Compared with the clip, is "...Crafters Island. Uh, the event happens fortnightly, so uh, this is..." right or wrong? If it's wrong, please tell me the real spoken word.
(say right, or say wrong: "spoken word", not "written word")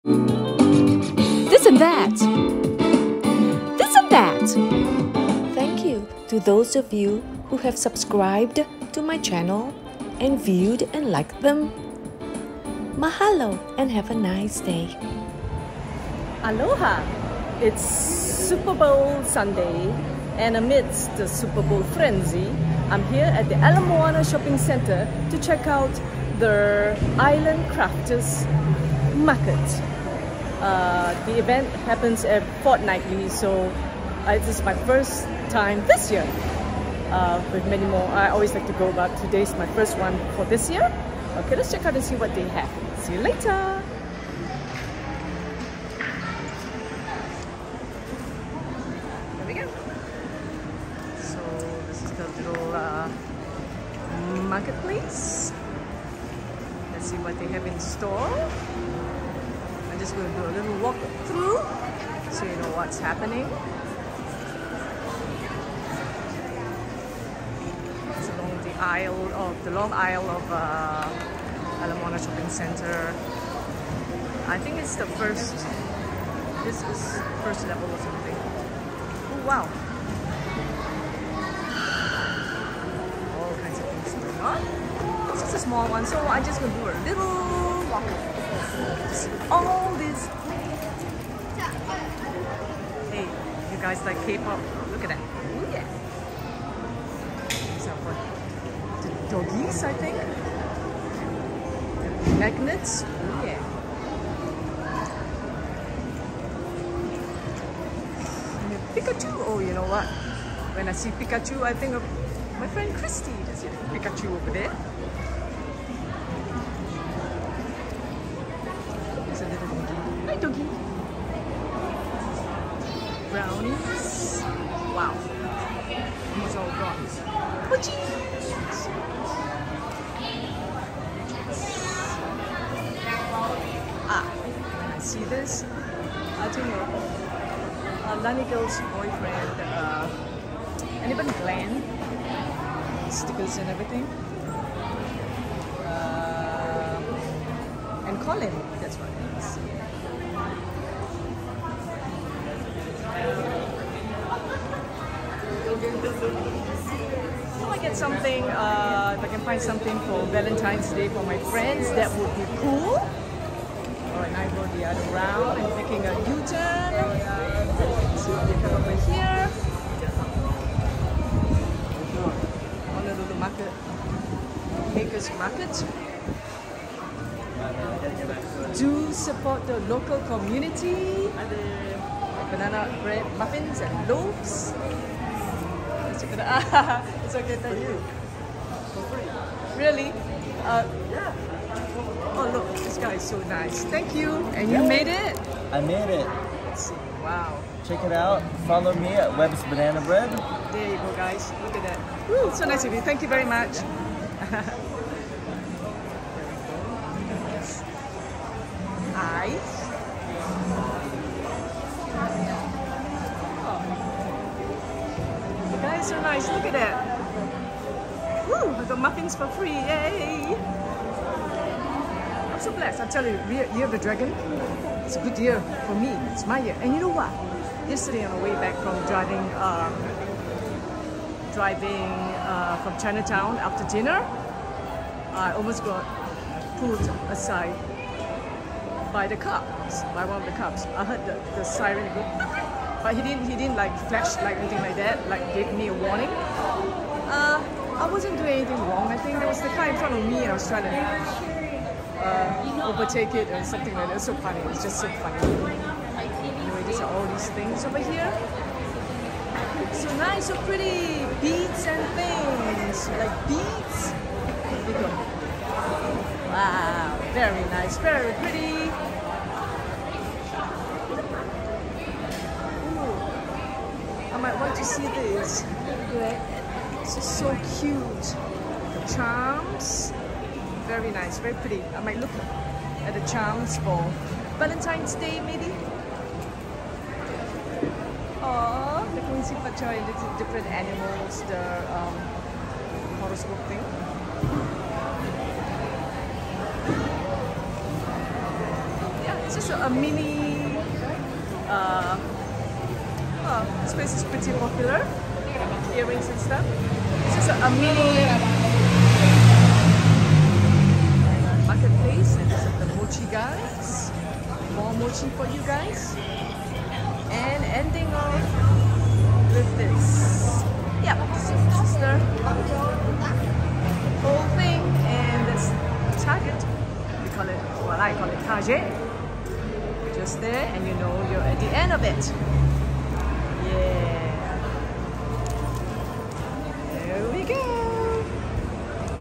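wrong: "Market", not "Island".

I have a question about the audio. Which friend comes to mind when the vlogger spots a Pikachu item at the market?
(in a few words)
Christy.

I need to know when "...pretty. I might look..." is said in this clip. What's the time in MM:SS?
04:41.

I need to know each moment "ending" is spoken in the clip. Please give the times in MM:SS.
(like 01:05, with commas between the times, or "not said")
05:17.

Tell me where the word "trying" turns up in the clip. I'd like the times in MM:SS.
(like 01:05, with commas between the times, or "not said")
04:10.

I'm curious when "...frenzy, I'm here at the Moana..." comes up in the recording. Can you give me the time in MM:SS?
00:21.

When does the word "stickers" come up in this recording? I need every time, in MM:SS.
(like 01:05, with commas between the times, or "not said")
02:23.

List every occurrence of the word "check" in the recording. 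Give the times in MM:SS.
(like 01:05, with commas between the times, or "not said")
00:25, 00:41, 03:17.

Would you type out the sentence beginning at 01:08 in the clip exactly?
aisle of the long aisle of uh, Ala Moana Shopping Center.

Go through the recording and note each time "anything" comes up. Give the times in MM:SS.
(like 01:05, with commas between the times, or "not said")
04:04, 04:08.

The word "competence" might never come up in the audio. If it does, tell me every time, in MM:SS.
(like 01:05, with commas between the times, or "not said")
not said.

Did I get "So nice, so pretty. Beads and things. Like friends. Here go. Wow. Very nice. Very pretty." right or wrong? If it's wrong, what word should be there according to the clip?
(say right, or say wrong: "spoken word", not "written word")
wrong: "beads", not "friends".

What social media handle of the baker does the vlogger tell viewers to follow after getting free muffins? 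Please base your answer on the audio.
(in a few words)
Webb's Banana Bread.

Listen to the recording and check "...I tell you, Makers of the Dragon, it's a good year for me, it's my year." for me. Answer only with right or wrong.
wrong.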